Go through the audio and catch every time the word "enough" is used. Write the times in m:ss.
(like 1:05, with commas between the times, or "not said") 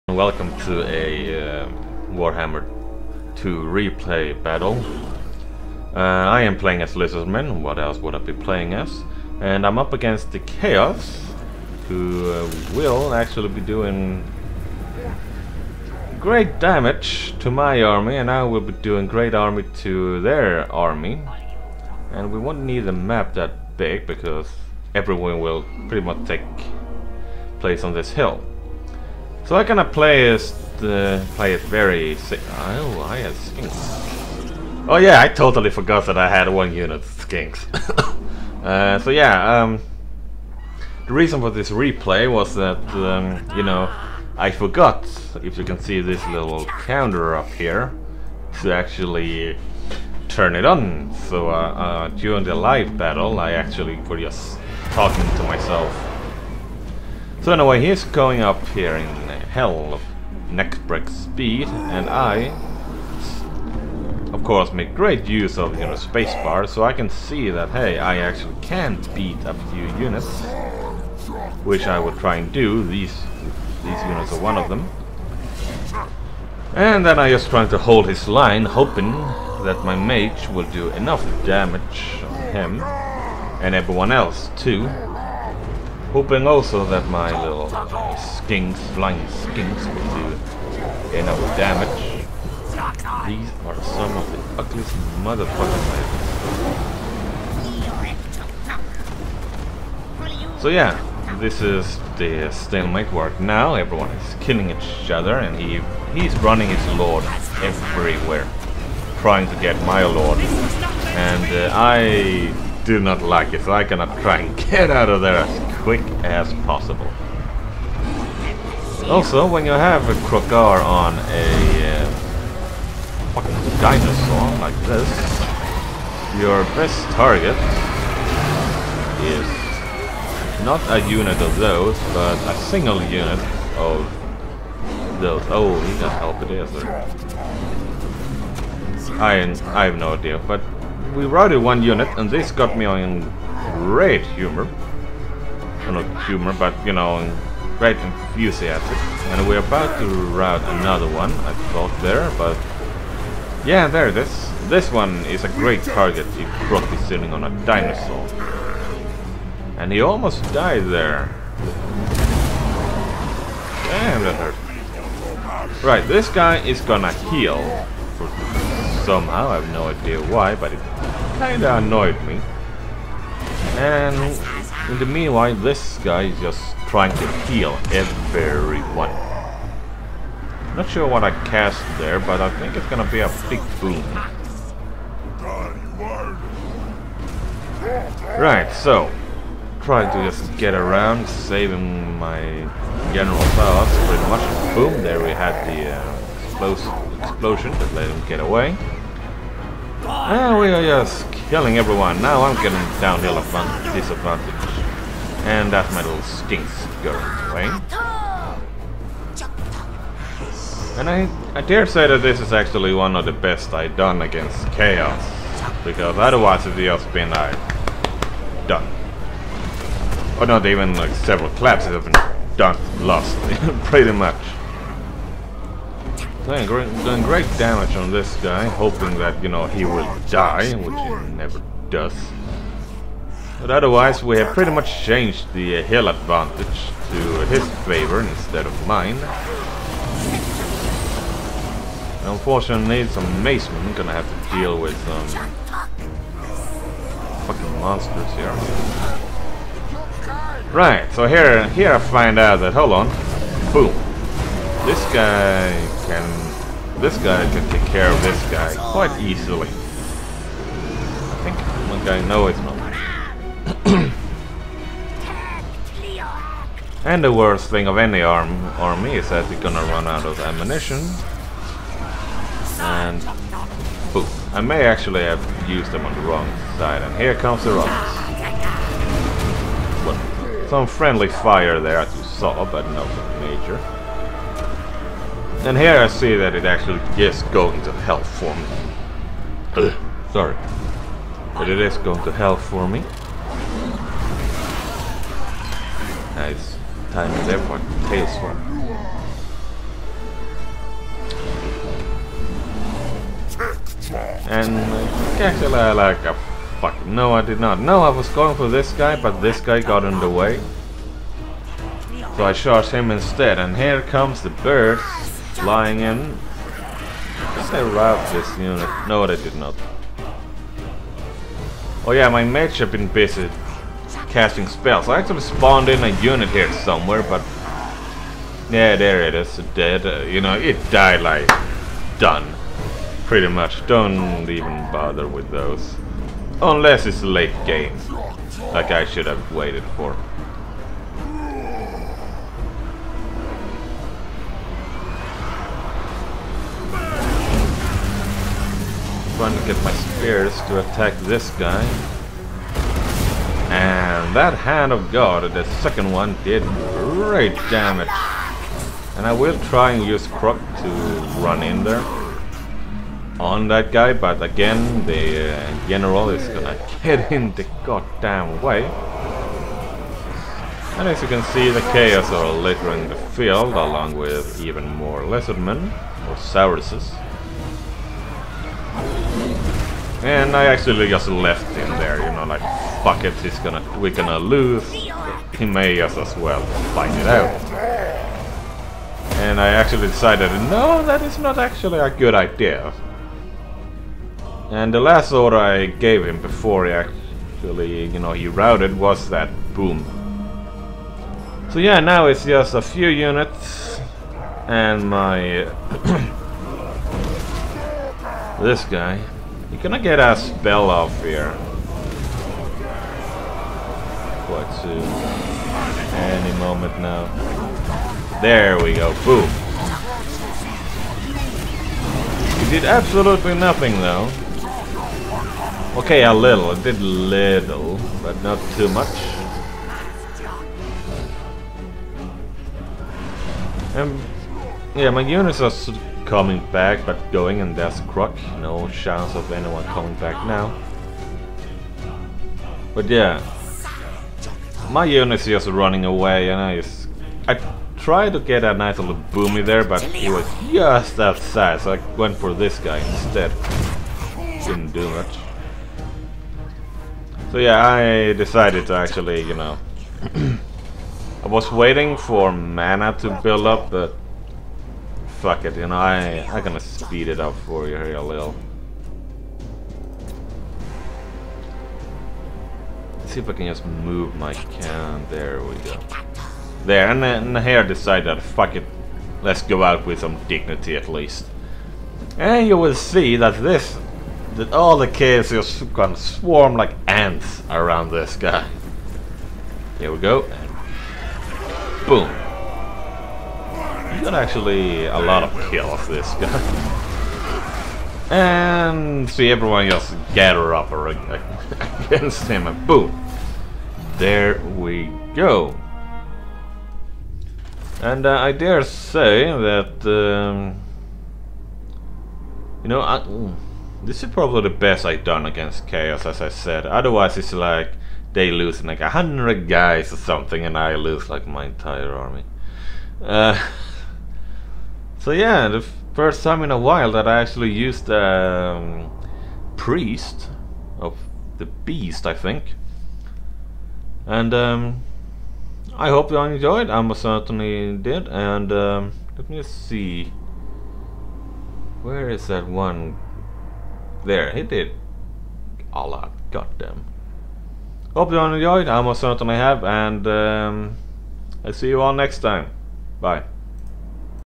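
1:20, 1:31.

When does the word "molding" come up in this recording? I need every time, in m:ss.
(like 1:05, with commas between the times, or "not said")
not said.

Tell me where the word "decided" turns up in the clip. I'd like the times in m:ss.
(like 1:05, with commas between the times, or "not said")
6:30, 7:38, 7:57.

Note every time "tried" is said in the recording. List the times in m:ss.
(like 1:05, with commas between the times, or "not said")
7:27.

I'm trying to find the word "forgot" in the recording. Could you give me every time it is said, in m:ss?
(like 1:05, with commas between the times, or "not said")
0:35, 0:44.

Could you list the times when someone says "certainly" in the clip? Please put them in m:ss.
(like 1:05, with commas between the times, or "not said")
8:57, 9:09.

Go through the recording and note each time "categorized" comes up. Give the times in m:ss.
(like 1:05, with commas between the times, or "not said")
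not said.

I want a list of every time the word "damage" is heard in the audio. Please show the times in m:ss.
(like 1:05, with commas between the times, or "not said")
0:16, 1:21, 1:31, 3:47, 5:57.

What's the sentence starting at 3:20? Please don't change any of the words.
And we are just killing everyone.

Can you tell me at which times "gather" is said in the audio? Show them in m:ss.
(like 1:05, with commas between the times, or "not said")
8:20.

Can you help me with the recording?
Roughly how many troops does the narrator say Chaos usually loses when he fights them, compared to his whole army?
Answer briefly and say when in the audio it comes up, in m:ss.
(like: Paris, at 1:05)
100, at 8:39.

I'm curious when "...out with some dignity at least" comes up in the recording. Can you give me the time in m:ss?
7:59.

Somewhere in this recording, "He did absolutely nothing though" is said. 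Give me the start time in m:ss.
7:02.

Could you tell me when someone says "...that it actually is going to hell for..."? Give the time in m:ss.
4:46.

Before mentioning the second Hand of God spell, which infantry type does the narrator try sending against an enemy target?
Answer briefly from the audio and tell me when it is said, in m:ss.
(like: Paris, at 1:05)
spears, at 5:49.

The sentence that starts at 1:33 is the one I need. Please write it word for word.
These are some of the ugliest motherfucking items.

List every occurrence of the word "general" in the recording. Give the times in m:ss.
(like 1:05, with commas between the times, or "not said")
3:13, 6:05.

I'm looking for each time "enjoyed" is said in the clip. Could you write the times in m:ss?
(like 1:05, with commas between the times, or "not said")
8:56, 9:08.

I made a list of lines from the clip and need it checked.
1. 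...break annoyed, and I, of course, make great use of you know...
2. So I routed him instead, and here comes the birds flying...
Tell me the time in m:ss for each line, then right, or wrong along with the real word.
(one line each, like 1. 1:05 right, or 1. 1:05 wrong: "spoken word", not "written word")
1. 1:00 wrong: "speed", not "annoyed"
2. 5:12 wrong: "charged", not "routed".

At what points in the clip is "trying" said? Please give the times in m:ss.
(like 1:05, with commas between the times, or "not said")
1:17, 1:49, 2:56, 5:49.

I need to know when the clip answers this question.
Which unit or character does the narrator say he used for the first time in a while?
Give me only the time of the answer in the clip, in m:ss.
8:49.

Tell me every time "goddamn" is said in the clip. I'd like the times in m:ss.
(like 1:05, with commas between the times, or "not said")
6:07, 9:06.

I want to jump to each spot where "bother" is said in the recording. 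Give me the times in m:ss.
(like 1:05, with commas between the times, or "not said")
5:34.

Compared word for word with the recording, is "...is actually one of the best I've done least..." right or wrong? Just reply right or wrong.
wrong.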